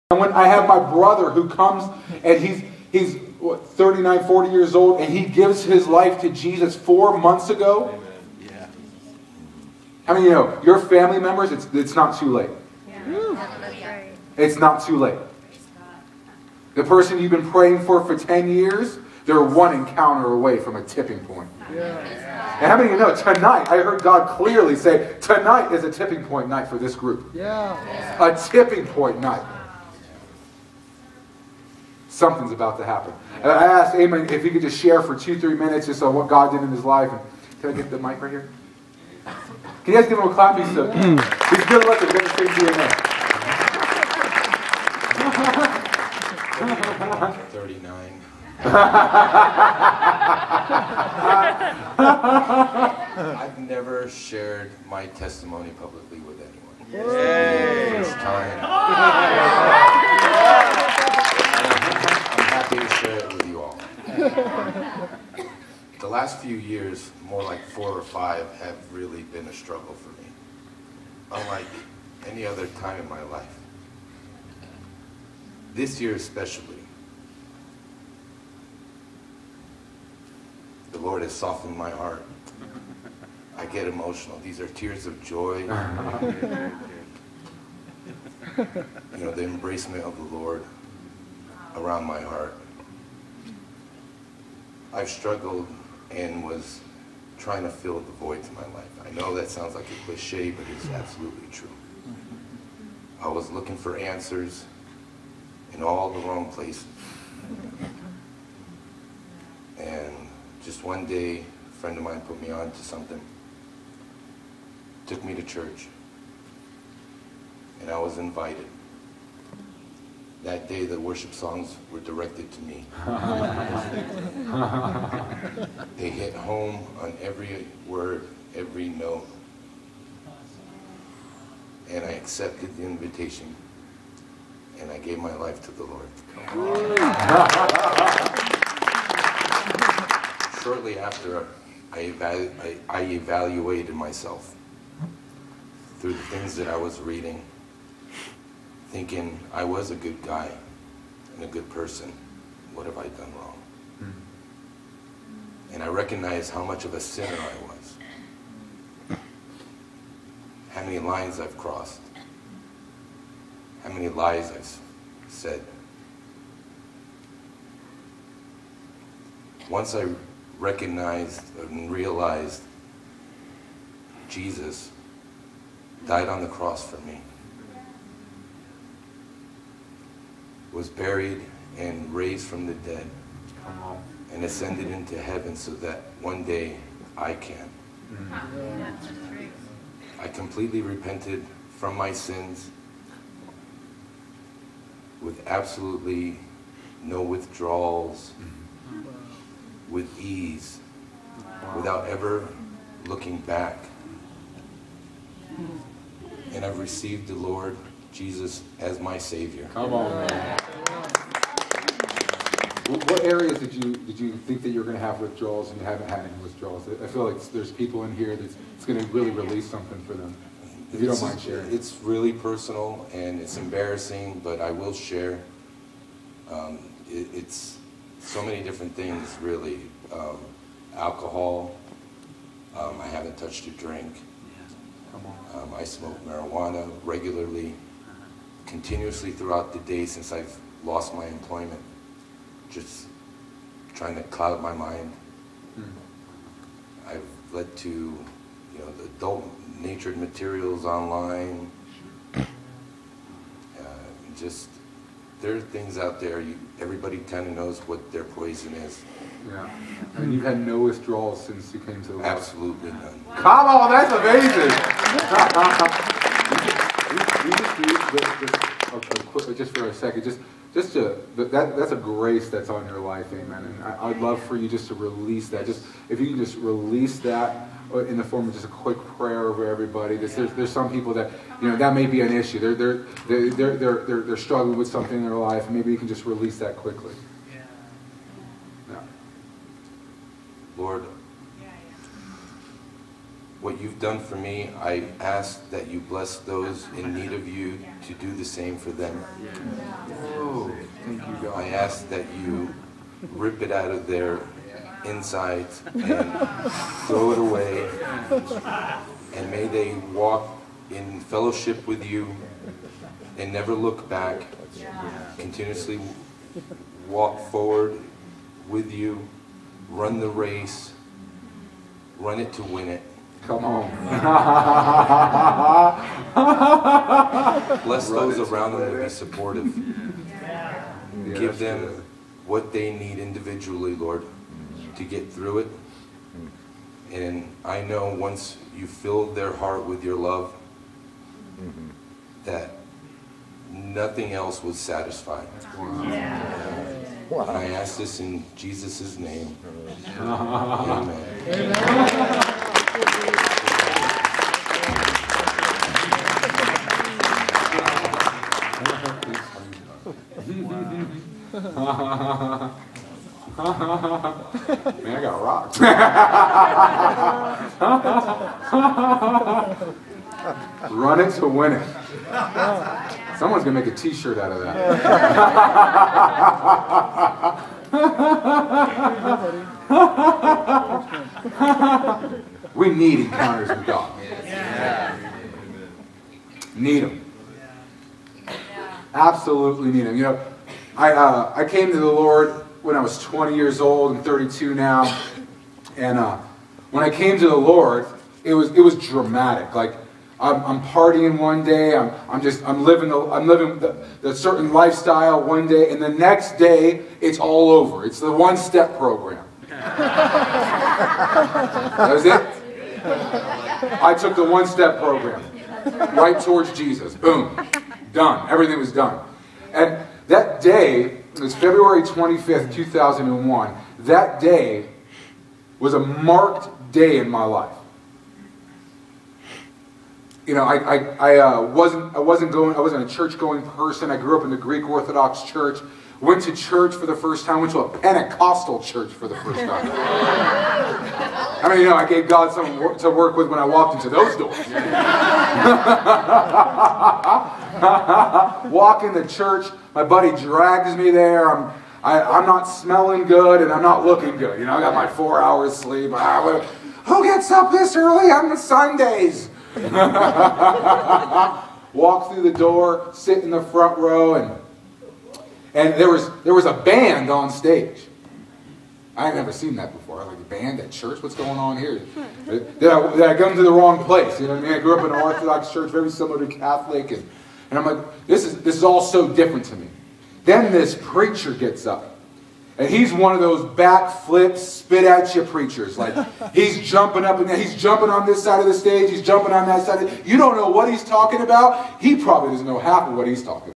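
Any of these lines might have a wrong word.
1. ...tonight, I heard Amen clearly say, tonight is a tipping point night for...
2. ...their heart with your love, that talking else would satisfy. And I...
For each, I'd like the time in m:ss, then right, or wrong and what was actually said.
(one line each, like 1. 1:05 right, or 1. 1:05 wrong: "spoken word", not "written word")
1. 0:23 wrong: "God", not "Amen"
2. 5:39 wrong: "nothing", not "talking".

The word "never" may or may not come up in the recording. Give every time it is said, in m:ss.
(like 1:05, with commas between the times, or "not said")
0:53, 5:13, 7:49.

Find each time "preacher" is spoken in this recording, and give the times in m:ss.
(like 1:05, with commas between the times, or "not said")
8:01, 8:05.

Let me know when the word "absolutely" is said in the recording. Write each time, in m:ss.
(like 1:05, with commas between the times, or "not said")
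1:40, 3:15, 4:22, 6:29.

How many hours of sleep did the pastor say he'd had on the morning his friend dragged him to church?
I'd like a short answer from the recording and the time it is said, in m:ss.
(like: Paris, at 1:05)
4 hours, at 7:35.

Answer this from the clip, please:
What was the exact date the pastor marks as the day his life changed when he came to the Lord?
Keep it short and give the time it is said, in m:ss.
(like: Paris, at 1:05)
February 25, 2001, at 7:01.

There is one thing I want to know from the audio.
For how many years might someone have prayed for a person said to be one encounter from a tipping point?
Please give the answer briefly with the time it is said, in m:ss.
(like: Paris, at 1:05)
10 years, at 0:18.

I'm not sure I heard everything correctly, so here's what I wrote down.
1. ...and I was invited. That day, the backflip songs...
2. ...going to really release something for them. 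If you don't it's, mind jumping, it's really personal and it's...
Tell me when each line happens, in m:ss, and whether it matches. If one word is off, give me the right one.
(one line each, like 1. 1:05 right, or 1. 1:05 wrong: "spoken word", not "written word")
1. 1:57 wrong: "worship", not "backflip"
2. 3:38 wrong: "sharing", not "jumping".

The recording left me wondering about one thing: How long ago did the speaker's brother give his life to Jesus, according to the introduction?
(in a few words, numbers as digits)
4 months ago.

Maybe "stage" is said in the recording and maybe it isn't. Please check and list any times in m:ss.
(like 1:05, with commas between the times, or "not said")
7:47, 8:08.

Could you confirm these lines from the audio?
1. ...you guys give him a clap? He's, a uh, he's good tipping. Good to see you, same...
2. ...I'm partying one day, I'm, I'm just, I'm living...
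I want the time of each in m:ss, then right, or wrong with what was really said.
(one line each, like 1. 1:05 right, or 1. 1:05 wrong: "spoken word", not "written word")
1. 0:39 wrong: "looking", not "tipping"
2. 6:40 right.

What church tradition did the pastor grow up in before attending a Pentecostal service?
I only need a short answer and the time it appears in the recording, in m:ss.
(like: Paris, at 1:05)
Greek Orthodox Church, at 7:14.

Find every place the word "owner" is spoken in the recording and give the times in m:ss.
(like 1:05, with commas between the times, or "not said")
not said.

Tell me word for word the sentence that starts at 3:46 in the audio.
Um, it, it's so many different things, really.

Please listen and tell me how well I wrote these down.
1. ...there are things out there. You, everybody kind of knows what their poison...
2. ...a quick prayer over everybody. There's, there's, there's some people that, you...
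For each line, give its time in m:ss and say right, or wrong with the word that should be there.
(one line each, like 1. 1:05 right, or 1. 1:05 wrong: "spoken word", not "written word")
1. 4:15 right
2. 4:38 right.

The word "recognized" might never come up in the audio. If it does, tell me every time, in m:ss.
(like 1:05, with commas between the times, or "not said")
2:35, 2:50.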